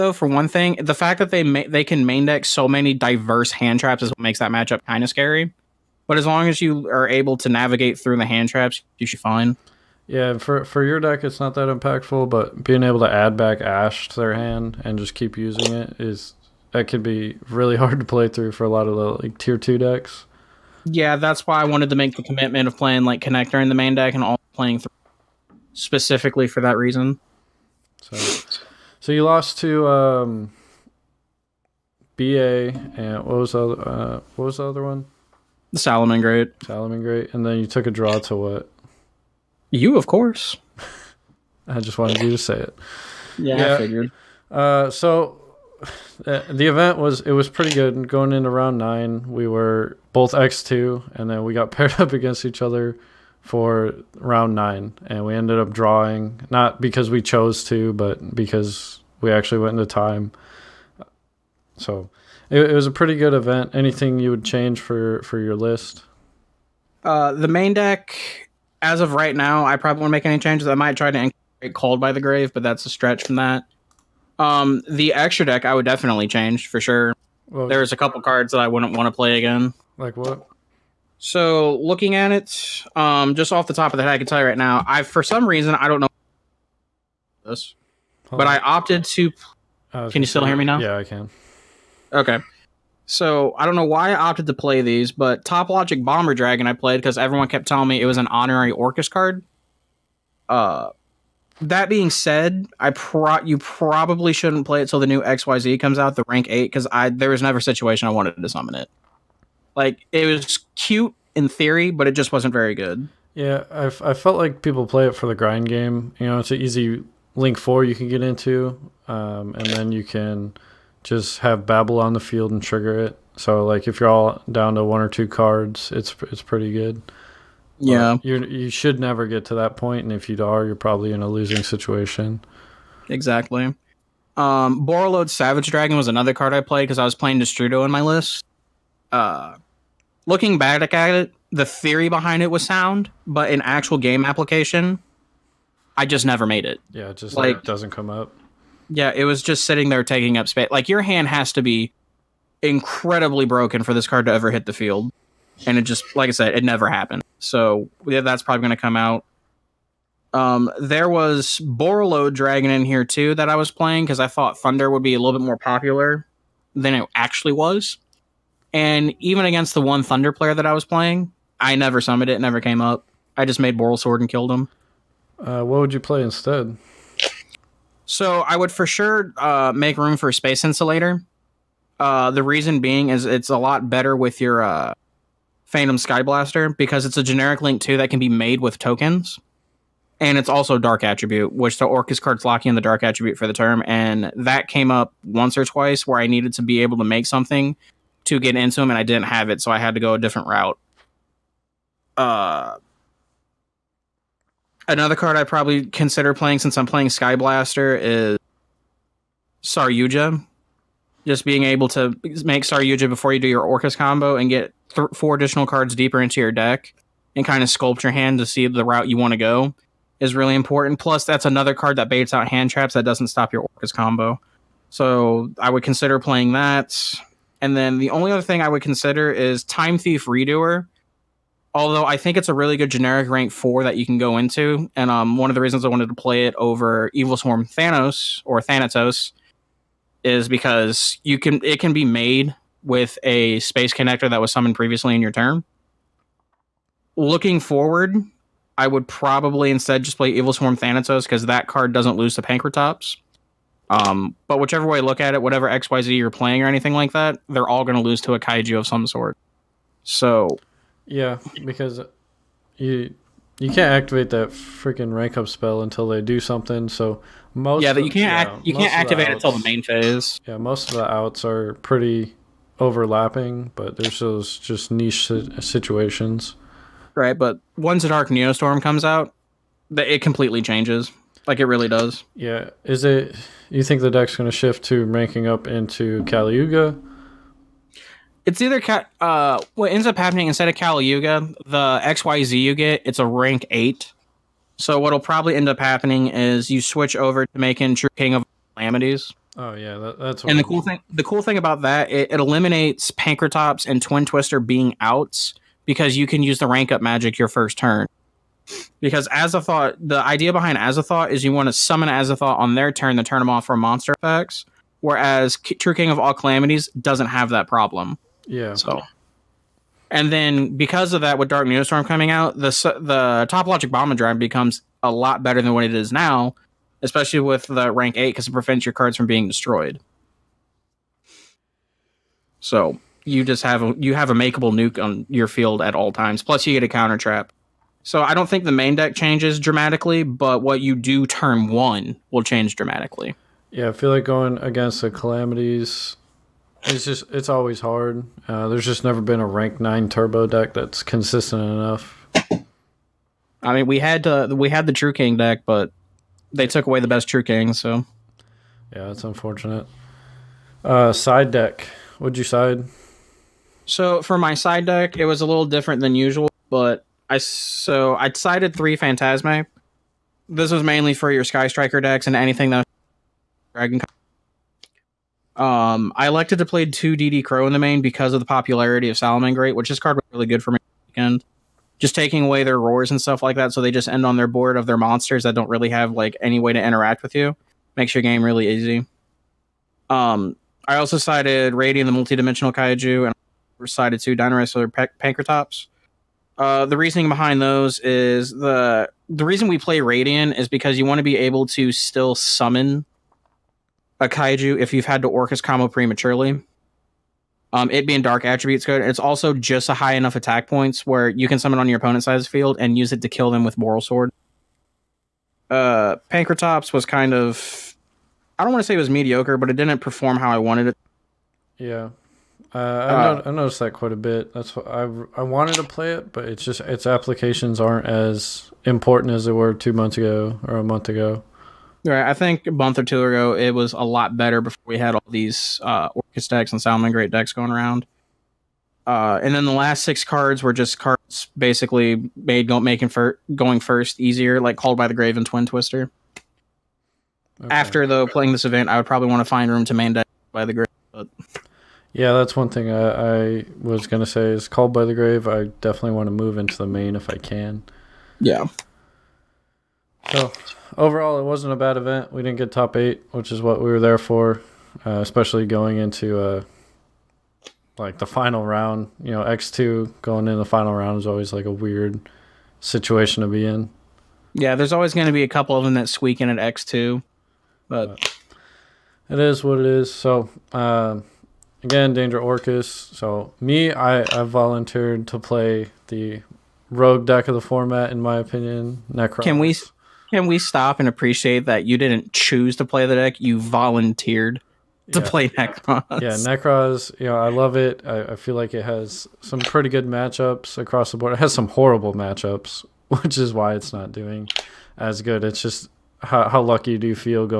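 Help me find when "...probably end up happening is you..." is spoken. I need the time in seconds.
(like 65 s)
295 s.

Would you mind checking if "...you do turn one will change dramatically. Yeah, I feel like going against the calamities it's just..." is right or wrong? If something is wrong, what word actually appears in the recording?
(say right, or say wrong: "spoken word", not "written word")
right.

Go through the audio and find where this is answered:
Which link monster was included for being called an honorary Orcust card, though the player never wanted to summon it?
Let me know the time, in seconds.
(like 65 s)
95 s.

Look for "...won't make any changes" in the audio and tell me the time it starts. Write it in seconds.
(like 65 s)
70 s.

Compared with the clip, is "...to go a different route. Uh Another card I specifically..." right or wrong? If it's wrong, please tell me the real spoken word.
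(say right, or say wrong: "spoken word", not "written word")
wrong: "probably", not "specifically".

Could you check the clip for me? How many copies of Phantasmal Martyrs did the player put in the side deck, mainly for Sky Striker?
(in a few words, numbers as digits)
3.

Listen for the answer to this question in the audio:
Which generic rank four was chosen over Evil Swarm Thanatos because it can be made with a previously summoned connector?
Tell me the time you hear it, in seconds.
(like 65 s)
229 s.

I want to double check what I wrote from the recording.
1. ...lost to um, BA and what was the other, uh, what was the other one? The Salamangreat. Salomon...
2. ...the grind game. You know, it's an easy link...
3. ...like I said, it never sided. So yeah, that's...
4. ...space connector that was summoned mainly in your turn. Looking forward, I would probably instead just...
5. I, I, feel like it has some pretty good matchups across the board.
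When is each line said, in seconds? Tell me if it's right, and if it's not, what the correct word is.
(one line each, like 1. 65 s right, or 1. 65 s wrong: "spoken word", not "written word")
1. 29 s right
2. 115 s right
3. 156 s wrong: "happened", not "sided"
4. 243 s wrong: "previously", not "mainly"
5. 498 s right.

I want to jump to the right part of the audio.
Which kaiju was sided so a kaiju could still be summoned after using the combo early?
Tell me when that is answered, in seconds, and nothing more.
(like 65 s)
391 s.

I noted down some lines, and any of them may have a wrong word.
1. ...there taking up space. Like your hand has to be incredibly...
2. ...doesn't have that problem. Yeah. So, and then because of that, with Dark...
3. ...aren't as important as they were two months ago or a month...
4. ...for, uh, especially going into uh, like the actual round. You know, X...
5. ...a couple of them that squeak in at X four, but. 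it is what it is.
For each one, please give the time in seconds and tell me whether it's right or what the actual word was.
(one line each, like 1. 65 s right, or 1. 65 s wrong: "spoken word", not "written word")
1. 149 s right
2. 316 s right
3. 427 s right
4. 464 s wrong: "final", not "actual"
5. 475 s wrong: "two", not "four".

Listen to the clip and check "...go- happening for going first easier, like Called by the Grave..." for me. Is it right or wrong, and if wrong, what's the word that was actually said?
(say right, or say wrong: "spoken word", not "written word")
wrong: "making", not "happening".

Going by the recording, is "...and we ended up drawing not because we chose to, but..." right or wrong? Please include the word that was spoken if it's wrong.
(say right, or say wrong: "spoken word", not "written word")
right.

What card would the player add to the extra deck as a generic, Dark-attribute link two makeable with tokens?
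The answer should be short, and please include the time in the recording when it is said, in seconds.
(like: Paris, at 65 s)
Space Insulator, at 180 s.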